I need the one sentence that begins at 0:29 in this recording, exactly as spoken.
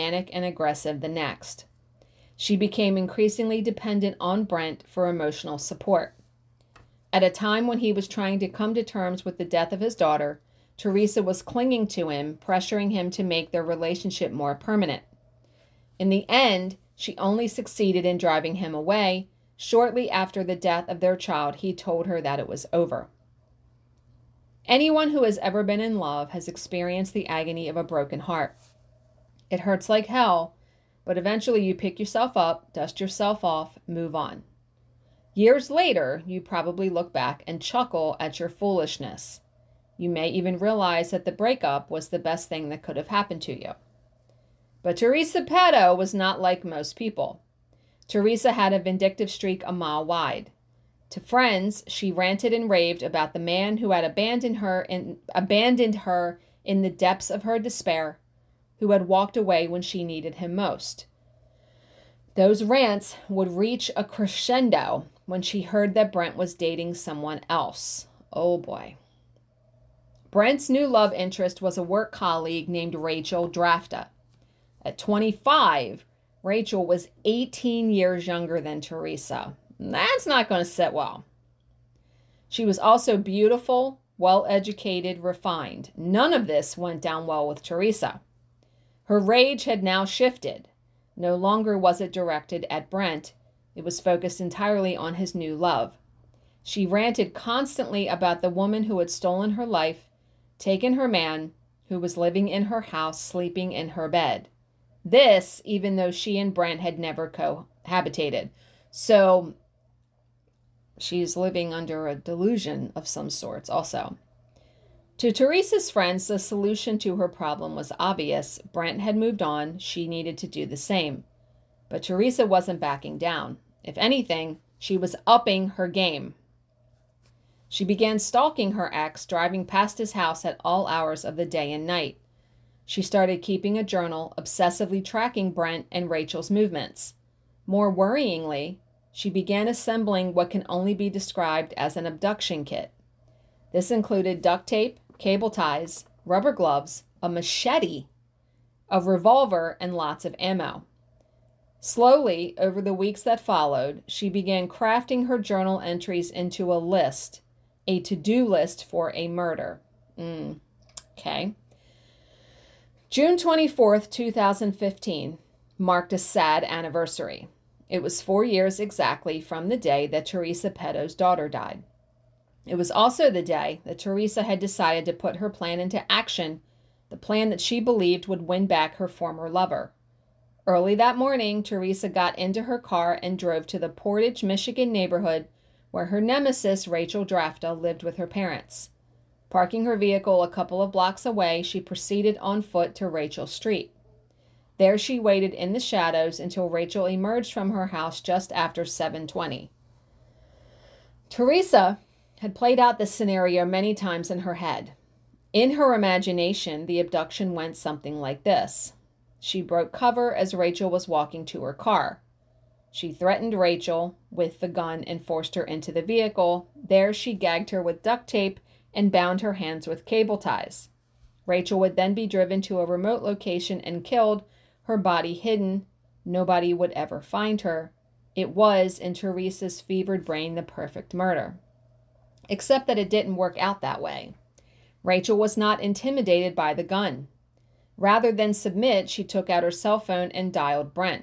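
It hurts like hell, but eventually you pick yourself up, dust yourself off, move on.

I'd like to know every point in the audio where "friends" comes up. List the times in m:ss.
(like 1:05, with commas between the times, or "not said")
0:51, 1:55.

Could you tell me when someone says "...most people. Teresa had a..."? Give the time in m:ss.
0:46.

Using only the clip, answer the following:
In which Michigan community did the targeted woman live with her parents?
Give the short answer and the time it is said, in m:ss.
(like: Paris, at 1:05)
Portage, at 3:03.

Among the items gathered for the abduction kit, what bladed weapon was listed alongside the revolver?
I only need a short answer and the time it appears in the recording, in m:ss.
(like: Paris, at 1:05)
machete, at 2:27.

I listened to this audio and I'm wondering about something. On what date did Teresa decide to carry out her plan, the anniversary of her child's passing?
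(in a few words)
June 24th, 2015.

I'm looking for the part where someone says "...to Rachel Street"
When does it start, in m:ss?
3:12.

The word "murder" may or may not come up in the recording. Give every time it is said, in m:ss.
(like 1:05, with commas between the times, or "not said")
2:39, 3:51.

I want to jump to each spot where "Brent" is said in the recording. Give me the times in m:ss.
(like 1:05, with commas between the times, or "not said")
0:04, 1:06, 1:10, 1:32, 1:46, 1:58, 2:15.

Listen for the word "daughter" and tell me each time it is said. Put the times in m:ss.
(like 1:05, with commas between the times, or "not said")
0:09, 2:51.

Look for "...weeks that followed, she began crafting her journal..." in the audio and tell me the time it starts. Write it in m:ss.
2:32.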